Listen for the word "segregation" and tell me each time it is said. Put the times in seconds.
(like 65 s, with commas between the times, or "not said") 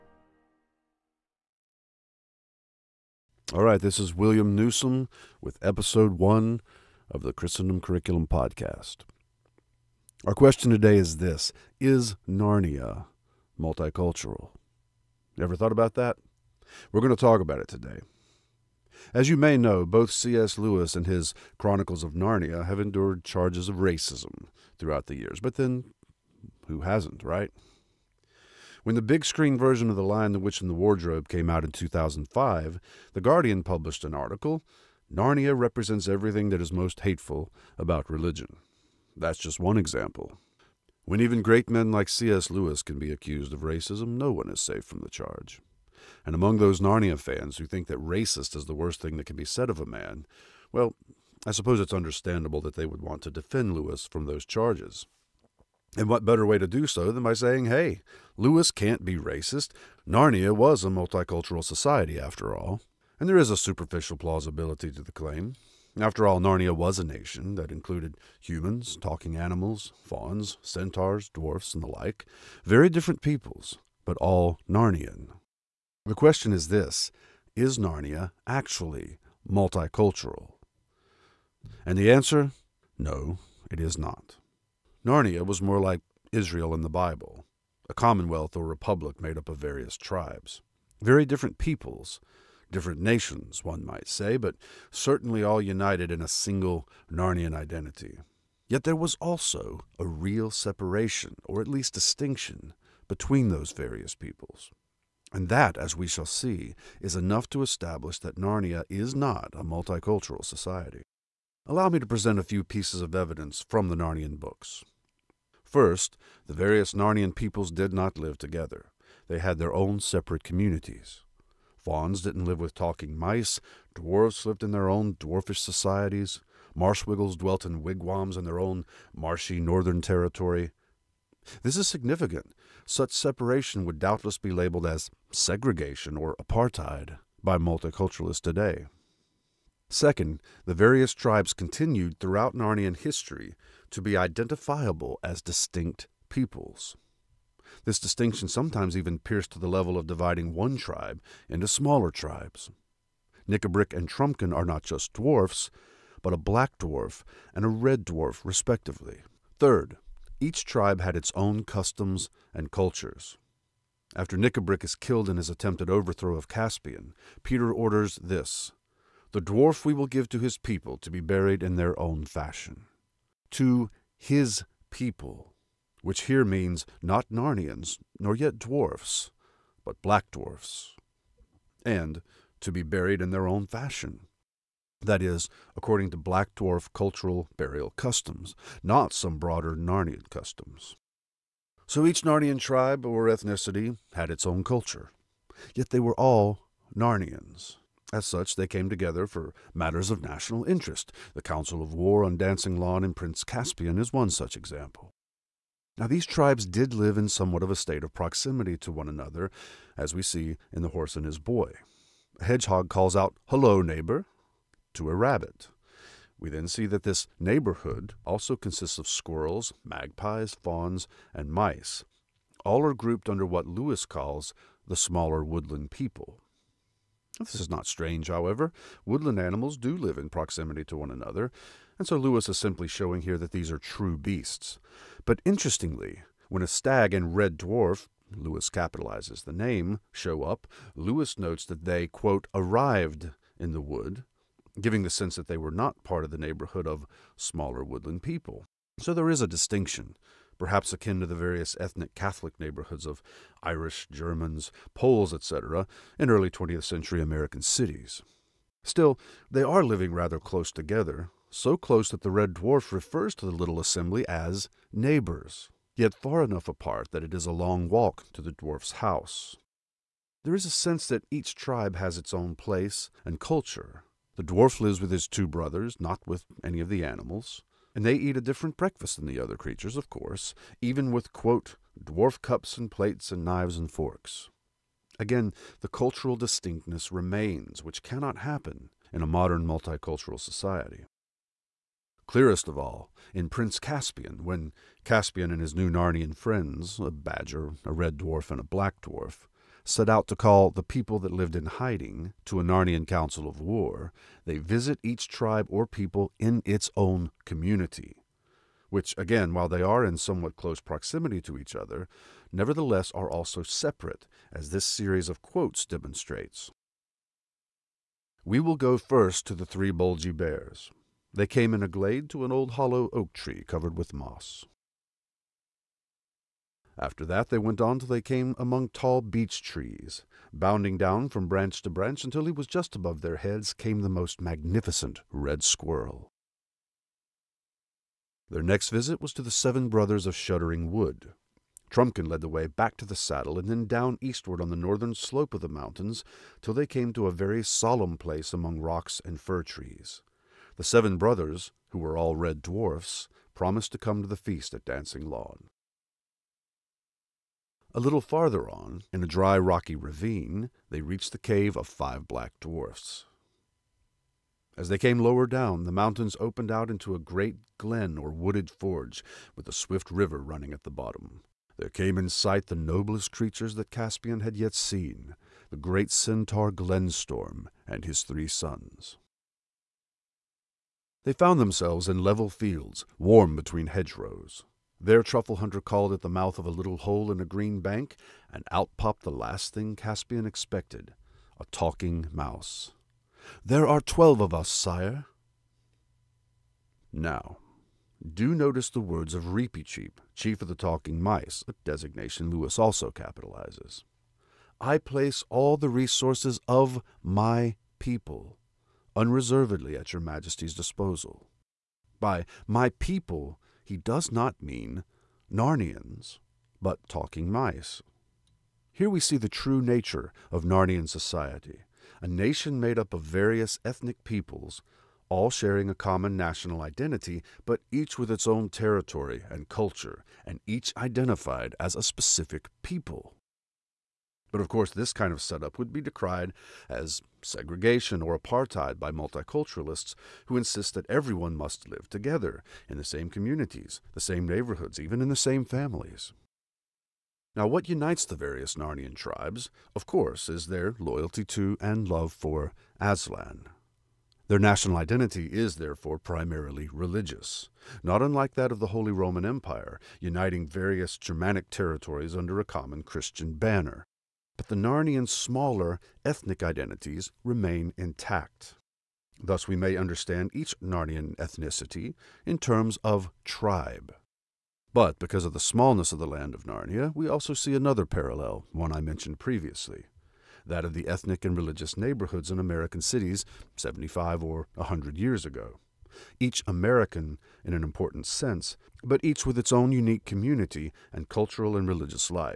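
135 s, 437 s.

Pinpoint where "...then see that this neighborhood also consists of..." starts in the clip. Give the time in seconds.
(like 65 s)
216 s.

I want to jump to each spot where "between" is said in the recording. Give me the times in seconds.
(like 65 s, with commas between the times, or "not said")
103 s, 383 s.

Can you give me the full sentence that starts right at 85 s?
Narnia was more like Israel in the Bible, a commonwealth or republic made up of various tribes.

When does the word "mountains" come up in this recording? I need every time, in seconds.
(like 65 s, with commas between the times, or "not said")
345 s, 365 s.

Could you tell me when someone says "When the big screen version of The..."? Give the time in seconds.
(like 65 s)
28 s.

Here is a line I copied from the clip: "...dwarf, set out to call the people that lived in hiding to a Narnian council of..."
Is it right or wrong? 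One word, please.
right.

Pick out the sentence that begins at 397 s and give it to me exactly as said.
Now, do notice the words of Reepicheep, chief of the talking mice, a designation Lewis also capitalizes.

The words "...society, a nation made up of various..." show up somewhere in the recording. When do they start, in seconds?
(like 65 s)
421 s.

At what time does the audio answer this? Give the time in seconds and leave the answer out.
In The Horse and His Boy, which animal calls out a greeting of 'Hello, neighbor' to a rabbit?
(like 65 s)
212 s.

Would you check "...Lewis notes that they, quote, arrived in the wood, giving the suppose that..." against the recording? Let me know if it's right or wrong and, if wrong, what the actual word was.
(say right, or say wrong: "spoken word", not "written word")
wrong: "sense", not "suppose".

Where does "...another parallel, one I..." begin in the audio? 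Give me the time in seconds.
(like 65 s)
477 s.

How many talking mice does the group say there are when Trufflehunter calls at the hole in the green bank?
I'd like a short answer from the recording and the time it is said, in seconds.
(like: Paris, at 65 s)
12, at 394 s.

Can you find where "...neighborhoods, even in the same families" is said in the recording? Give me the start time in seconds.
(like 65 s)
444 s.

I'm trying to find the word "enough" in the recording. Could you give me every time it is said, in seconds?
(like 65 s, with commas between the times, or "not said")
107 s, 266 s.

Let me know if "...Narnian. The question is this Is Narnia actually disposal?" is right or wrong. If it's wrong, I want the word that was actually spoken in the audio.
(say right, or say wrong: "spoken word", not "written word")
wrong: "multicultural", not "disposal".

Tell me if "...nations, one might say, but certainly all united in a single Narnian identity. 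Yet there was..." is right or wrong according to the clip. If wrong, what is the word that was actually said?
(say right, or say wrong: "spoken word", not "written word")
right.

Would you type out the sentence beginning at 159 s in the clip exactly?
Third, each tribe had its own customs and cultures.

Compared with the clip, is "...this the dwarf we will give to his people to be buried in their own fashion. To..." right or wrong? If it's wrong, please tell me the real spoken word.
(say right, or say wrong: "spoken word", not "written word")
right.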